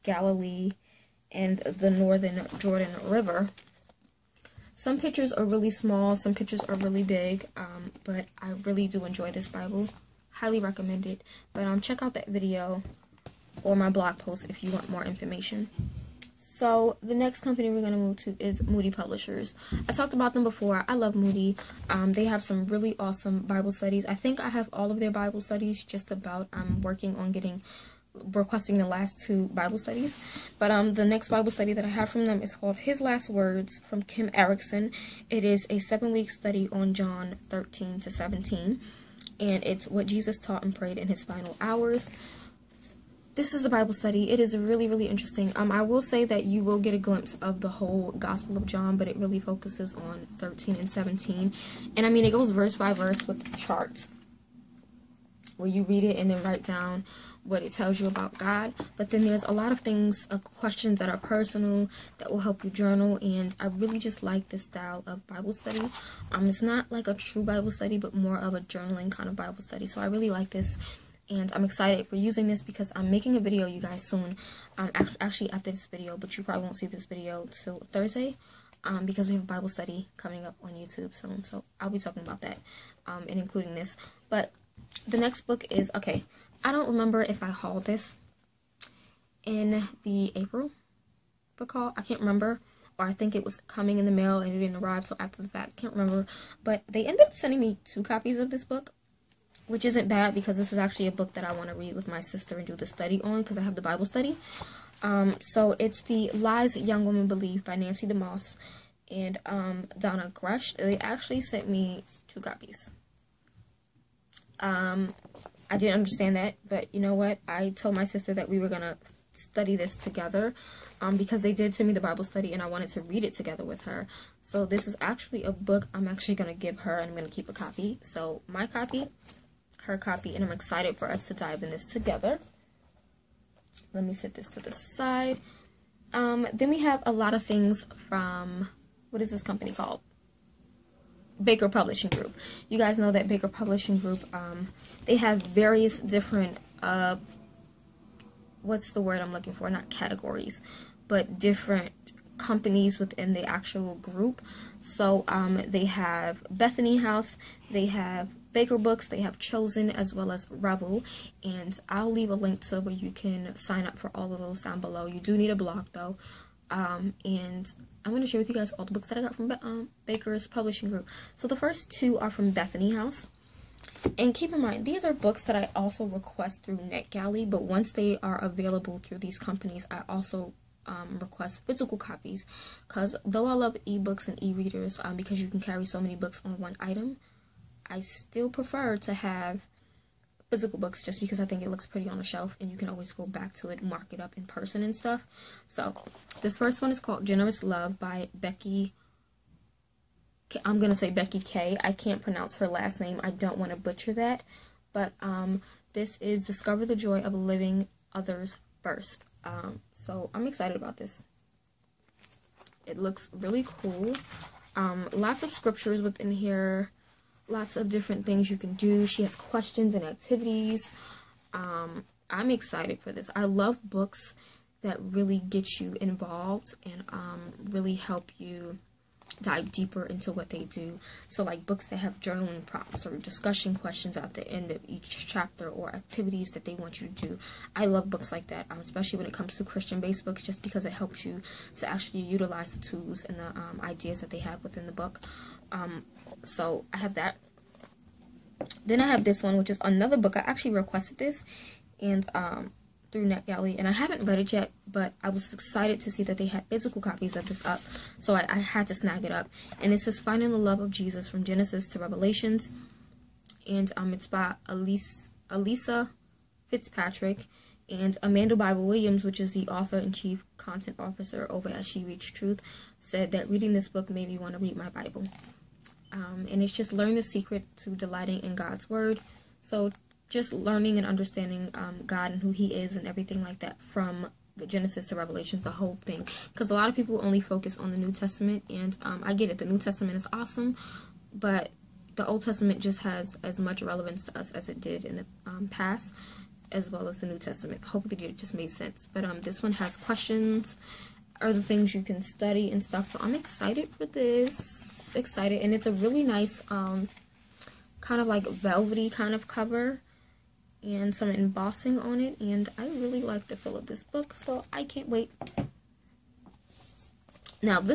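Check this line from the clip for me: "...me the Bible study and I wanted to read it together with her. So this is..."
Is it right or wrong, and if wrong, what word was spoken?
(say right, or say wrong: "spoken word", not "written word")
right.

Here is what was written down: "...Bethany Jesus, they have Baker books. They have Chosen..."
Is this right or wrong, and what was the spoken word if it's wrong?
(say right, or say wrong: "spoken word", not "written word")
wrong: "House", not "Jesus".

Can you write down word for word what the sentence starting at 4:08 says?
Then I have this one, which is another book.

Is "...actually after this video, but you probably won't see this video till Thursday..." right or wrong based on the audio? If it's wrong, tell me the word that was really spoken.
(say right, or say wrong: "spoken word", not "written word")
right.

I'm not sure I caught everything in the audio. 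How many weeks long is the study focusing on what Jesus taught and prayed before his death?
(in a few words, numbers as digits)
7.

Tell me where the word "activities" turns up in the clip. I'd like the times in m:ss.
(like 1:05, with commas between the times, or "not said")
3:40, 3:55.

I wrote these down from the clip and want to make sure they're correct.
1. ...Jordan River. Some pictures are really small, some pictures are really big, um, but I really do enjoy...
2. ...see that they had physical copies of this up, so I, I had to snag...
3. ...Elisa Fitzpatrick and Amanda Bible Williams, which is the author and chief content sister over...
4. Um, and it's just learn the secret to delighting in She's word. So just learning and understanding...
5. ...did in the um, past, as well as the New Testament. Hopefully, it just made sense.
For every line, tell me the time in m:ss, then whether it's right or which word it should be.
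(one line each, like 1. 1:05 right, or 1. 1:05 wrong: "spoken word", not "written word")
1. 0:02 right
2. 4:16 right
3. 4:25 wrong: "officer", not "sister"
4. 4:36 wrong: "God", not "She"
5. 4:54 right.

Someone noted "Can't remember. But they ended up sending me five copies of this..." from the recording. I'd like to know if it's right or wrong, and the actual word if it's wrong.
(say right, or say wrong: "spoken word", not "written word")
wrong: "two", not "five".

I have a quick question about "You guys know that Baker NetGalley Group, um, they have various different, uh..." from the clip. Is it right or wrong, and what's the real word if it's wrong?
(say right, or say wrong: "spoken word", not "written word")
wrong: "Publishing", not "NetGalley".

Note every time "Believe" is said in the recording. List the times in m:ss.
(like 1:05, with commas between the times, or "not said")
1:47.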